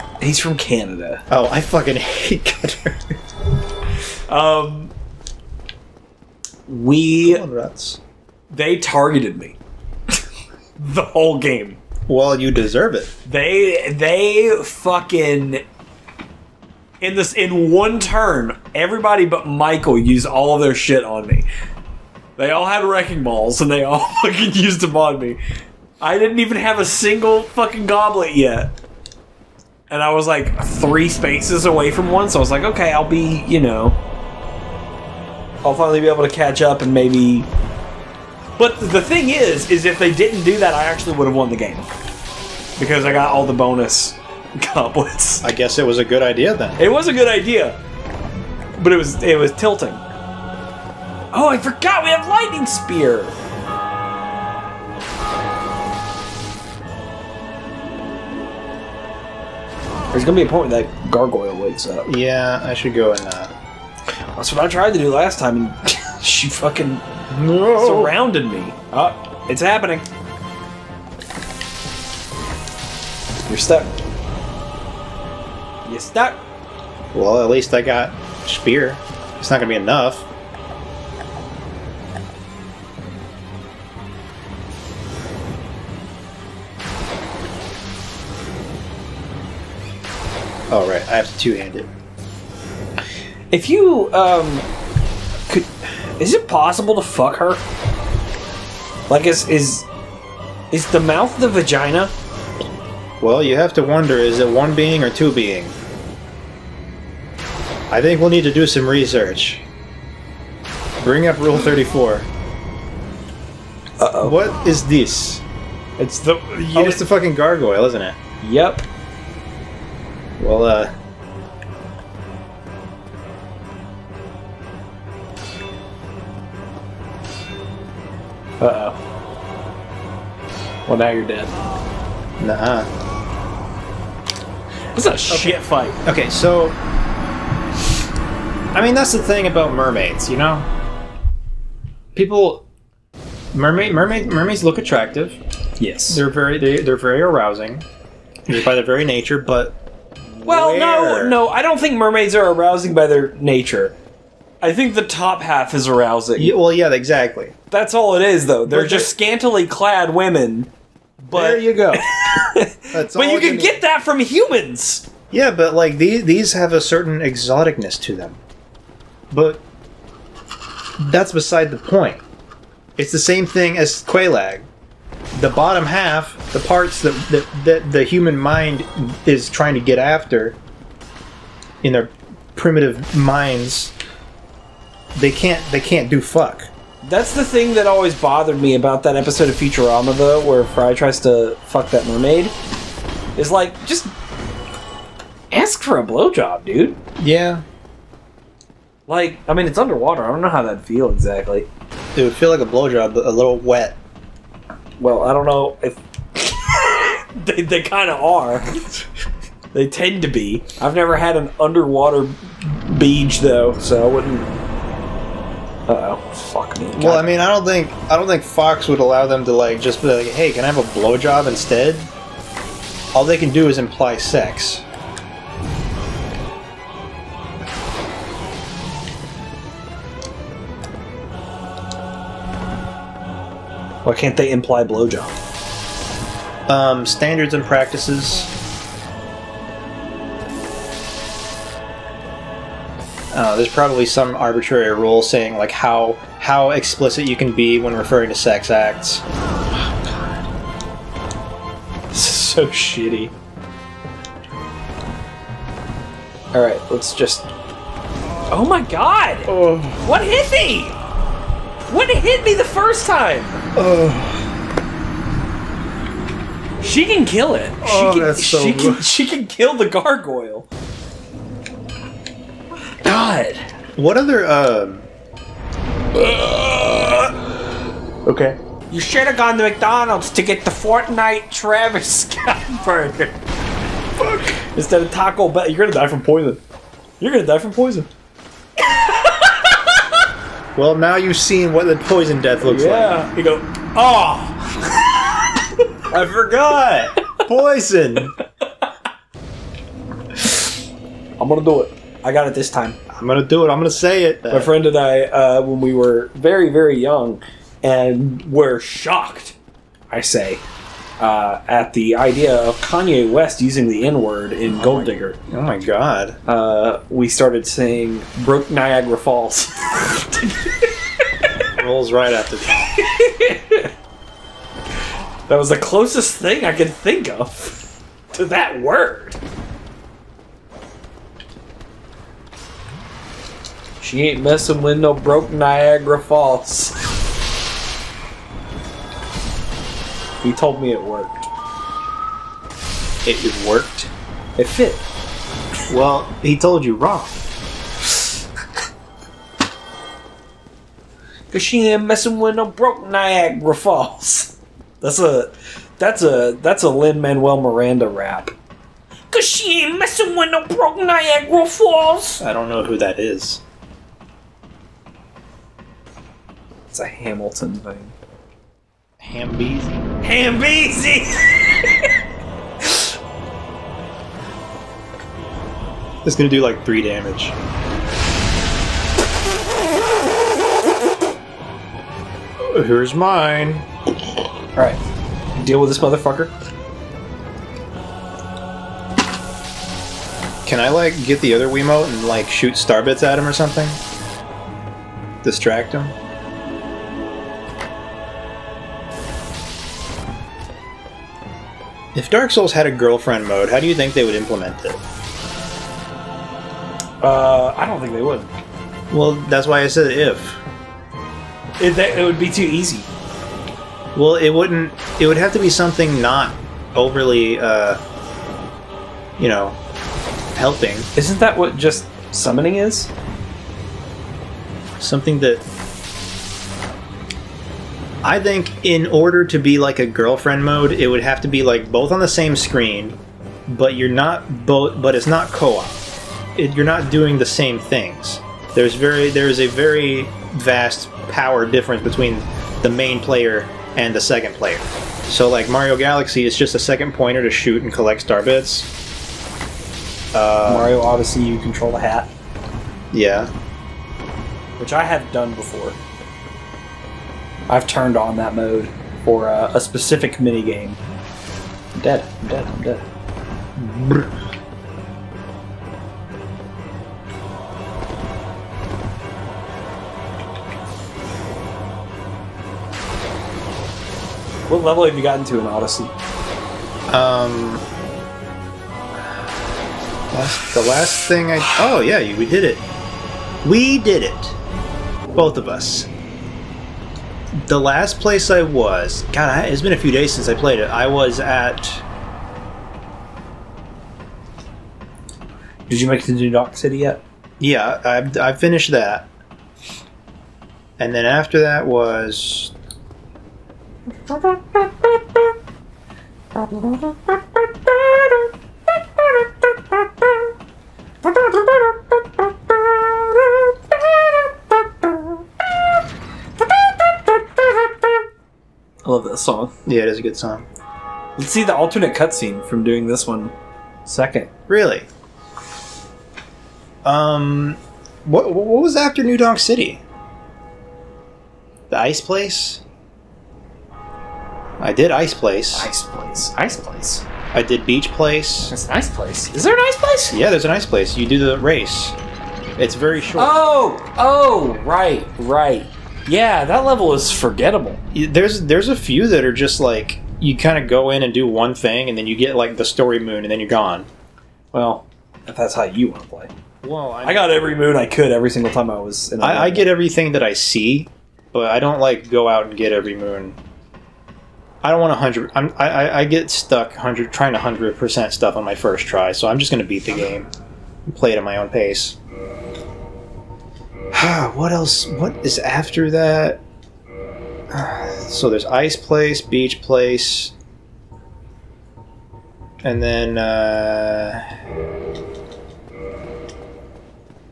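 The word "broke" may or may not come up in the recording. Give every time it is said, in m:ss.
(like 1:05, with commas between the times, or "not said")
5:18, 5:35, 5:52, 6:00.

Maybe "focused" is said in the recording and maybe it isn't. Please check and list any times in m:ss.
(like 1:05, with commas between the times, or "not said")
not said.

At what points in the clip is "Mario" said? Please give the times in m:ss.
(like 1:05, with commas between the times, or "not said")
7:25, 7:30.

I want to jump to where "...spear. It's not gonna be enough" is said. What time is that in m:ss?
1:18.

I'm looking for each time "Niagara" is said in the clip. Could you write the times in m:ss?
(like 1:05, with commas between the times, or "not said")
5:18, 5:35, 5:53, 6:00.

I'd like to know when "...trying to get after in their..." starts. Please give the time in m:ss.
2:59.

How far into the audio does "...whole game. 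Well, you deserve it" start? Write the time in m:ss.
0:11.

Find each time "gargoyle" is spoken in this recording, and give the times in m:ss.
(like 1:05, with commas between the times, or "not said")
1:01, 1:57, 4:29.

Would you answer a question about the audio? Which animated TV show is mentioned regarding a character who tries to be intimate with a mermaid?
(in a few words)
Futurama.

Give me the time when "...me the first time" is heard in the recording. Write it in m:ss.
4:22.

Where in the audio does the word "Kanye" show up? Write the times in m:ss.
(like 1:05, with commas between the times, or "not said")
5:12.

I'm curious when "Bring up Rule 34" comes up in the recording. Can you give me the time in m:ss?
1:51.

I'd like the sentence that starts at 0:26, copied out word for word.
I didn't even have a single fucking goblet yet.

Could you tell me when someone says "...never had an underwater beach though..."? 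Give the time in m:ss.
3:30.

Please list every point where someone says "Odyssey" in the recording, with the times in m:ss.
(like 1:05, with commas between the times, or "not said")
7:31, 7:55.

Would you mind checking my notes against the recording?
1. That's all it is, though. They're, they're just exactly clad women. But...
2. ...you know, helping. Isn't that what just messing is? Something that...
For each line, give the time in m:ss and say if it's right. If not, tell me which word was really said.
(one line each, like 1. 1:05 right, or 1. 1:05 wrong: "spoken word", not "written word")
1. 2:37 wrong: "scantily", not "exactly"
2. 6:59 wrong: "summoning", not "messing".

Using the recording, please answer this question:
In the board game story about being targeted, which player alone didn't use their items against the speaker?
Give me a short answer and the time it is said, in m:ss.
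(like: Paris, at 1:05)
Michael, at 0:19.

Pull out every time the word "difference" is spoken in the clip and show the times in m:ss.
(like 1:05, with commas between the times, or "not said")
7:21.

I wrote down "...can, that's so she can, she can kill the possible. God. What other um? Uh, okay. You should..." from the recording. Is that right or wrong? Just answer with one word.
wrong.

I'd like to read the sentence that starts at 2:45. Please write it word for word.
Yeah, but like these these have a certain exoticness to them.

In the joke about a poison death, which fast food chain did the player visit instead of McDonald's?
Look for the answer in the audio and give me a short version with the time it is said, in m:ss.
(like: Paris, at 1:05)
Taco Bell, at 4:45.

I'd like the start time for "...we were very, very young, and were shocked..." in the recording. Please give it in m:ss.
5:05.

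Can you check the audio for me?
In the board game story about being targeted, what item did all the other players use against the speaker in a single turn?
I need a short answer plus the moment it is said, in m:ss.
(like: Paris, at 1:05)
wrecking balls, at 0:22.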